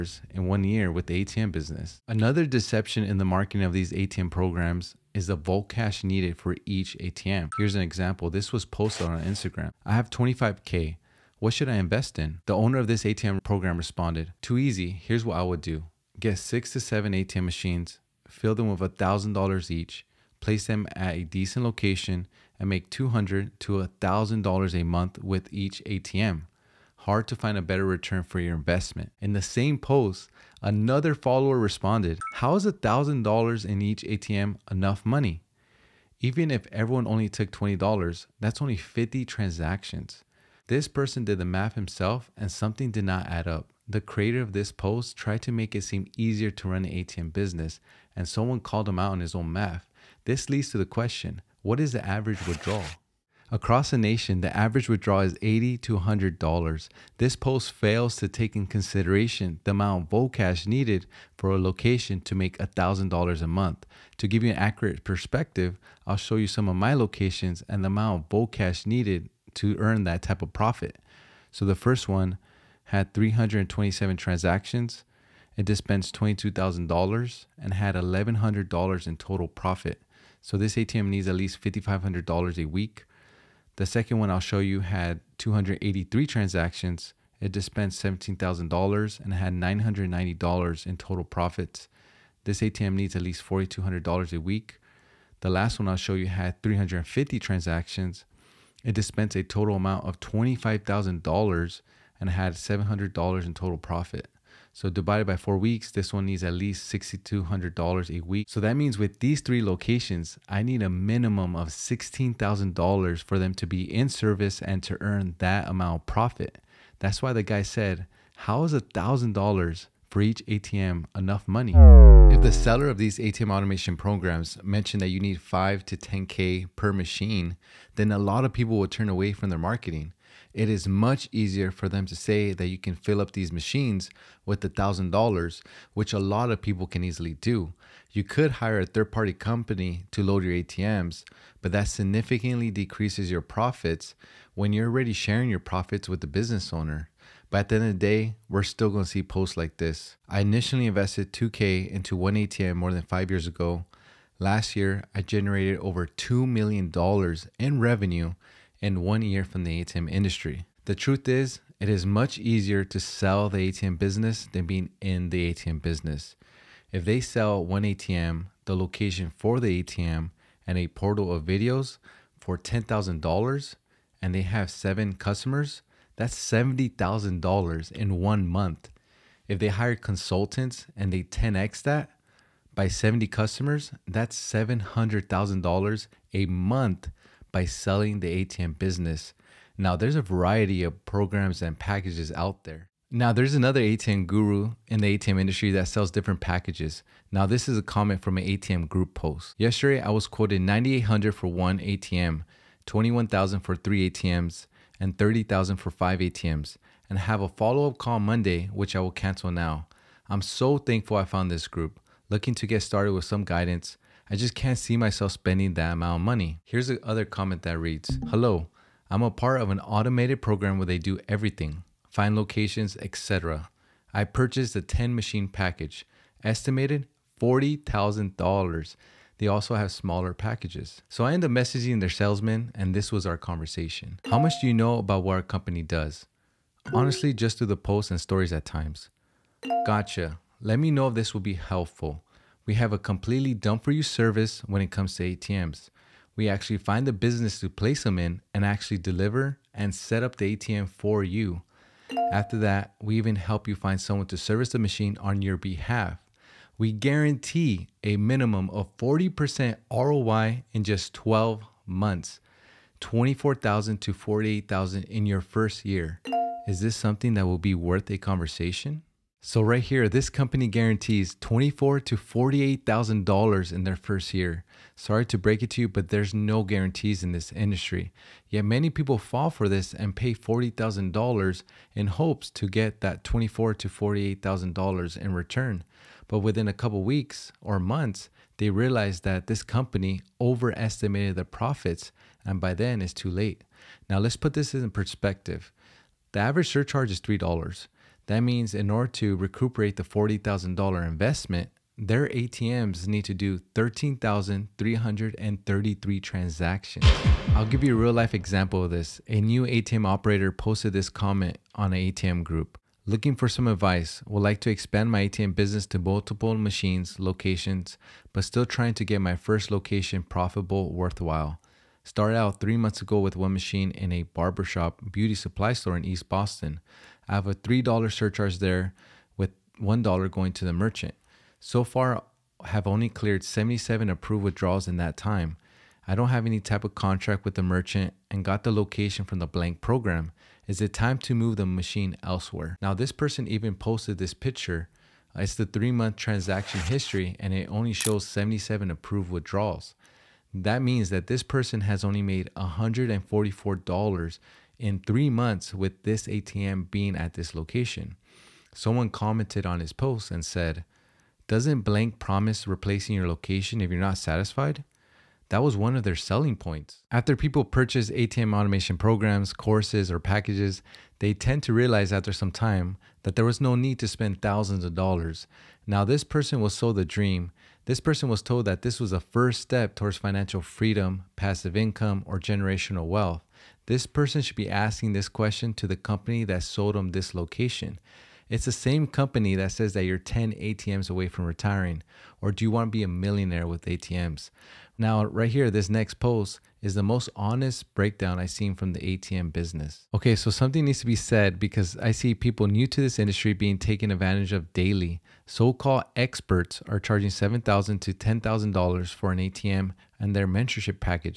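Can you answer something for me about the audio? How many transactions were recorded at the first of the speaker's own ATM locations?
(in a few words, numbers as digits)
327.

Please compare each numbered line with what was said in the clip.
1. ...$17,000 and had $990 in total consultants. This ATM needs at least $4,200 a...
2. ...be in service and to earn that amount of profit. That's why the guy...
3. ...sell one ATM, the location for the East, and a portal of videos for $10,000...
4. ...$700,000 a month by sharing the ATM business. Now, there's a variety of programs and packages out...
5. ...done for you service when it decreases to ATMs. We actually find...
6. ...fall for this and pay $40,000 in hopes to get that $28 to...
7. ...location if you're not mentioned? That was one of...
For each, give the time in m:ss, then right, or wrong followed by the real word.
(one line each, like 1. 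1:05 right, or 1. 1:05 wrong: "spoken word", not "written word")
1. 1:28 wrong: "profits", not "consultants"
2. 1:53 right
3. 2:47 wrong: "ATM", not "East"
4. 3:04 wrong: "selling", not "sharing"
5. 4:03 wrong: "comes", not "decreases"
6. 4:39 wrong: "24", not "28"
7. 6:03 wrong: "satisfied", not "mentioned".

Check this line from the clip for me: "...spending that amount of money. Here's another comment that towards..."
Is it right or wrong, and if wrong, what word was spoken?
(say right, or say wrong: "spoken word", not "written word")
wrong: "reads", not "towards".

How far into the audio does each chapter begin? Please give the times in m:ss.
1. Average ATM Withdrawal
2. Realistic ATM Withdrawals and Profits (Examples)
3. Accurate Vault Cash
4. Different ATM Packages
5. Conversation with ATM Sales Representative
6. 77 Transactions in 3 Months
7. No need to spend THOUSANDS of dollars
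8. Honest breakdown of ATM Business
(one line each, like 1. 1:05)
1. 0:52
2. 1:04
3. 1:49
4. 3:10
5. 3:51
6. 5:09
7. 6:07
8. 6:37.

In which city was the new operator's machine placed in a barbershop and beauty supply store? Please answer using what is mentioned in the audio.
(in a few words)
East Boston.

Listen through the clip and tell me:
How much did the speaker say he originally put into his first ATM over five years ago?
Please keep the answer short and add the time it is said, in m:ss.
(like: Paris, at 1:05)
2K, at 2:31.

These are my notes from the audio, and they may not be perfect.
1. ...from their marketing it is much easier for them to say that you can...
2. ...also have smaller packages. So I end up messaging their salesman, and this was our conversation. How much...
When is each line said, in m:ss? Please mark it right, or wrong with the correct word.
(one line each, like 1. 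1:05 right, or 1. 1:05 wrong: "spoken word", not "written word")
1. 2:09 right
2. 3:49 right.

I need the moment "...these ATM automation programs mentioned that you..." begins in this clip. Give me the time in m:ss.
2:02.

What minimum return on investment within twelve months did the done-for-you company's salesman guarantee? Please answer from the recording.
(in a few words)
40%.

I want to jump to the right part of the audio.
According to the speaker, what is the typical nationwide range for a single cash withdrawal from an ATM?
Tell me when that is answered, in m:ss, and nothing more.
0:55.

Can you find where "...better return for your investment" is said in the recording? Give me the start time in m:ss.
0:27.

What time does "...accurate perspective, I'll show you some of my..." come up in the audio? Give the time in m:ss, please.
1:04.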